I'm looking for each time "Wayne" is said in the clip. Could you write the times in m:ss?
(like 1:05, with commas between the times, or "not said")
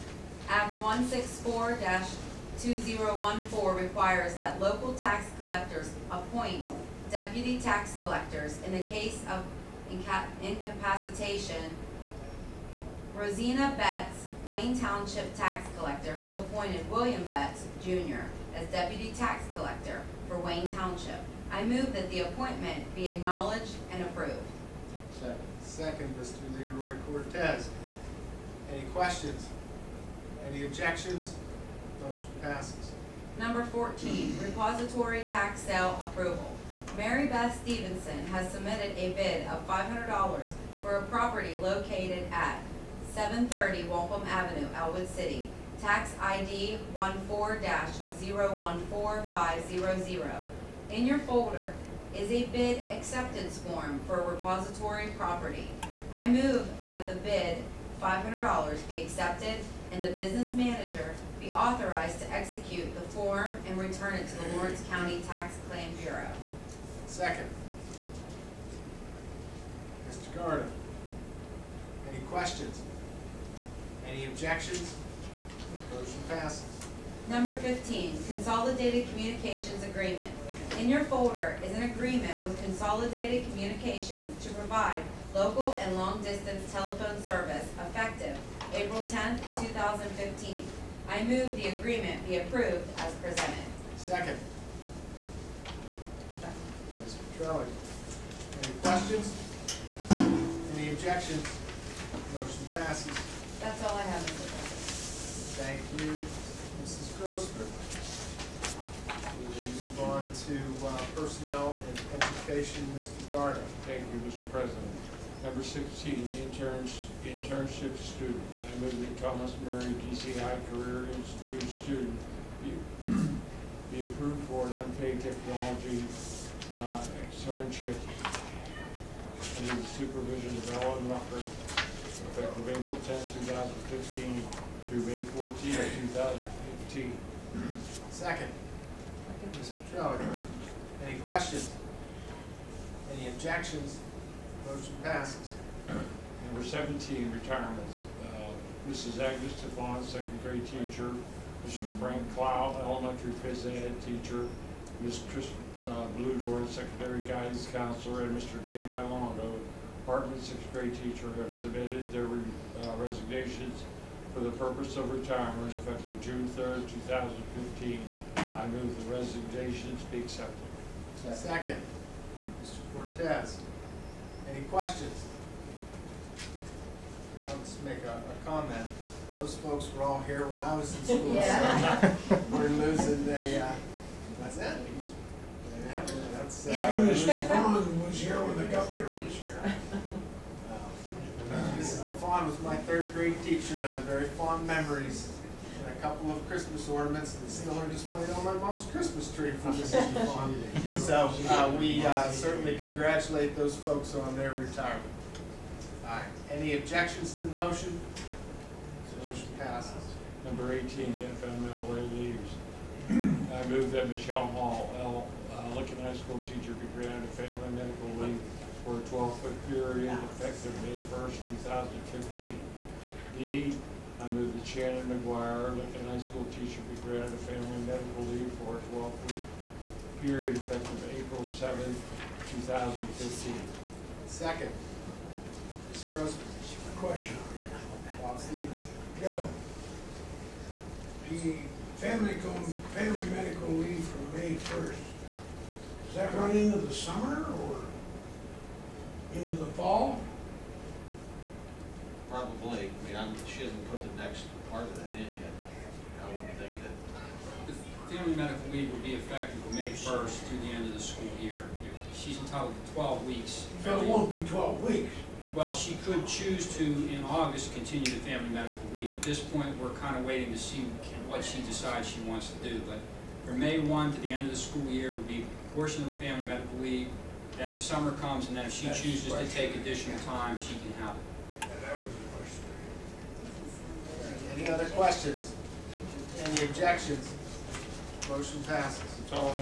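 0:14, 0:20.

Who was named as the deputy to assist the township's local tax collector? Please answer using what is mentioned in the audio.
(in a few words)
William Betts Jr.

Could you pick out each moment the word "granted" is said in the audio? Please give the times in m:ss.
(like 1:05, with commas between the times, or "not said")
3:36, 3:47.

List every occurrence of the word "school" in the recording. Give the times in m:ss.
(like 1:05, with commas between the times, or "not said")
3:01, 3:36, 3:46, 4:20, 4:34.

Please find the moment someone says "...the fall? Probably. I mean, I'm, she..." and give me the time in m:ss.
4:09.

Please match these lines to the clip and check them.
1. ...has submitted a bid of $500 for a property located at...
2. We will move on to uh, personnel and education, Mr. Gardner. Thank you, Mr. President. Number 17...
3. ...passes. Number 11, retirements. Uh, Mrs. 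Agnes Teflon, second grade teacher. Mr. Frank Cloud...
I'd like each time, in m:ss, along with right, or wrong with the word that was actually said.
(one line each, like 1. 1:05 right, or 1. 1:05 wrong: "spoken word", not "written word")
1. 0:38 right
2. 1:49 wrong: "16", not "17"
3. 2:25 wrong: "17", not "11".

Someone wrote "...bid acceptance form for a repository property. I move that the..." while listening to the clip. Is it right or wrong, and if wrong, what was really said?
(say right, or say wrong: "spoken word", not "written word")
right.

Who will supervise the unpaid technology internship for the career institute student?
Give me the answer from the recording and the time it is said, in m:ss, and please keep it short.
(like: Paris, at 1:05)
Ellen Rucker, at 2:10.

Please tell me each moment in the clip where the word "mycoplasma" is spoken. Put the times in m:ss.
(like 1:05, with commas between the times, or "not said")
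not said.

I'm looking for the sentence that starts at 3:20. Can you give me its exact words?
So uh, we uh, certainly congratulate those folks on their retirement.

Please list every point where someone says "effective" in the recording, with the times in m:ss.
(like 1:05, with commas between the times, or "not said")
1:27, 2:11, 2:45, 3:40, 3:50, 4:19.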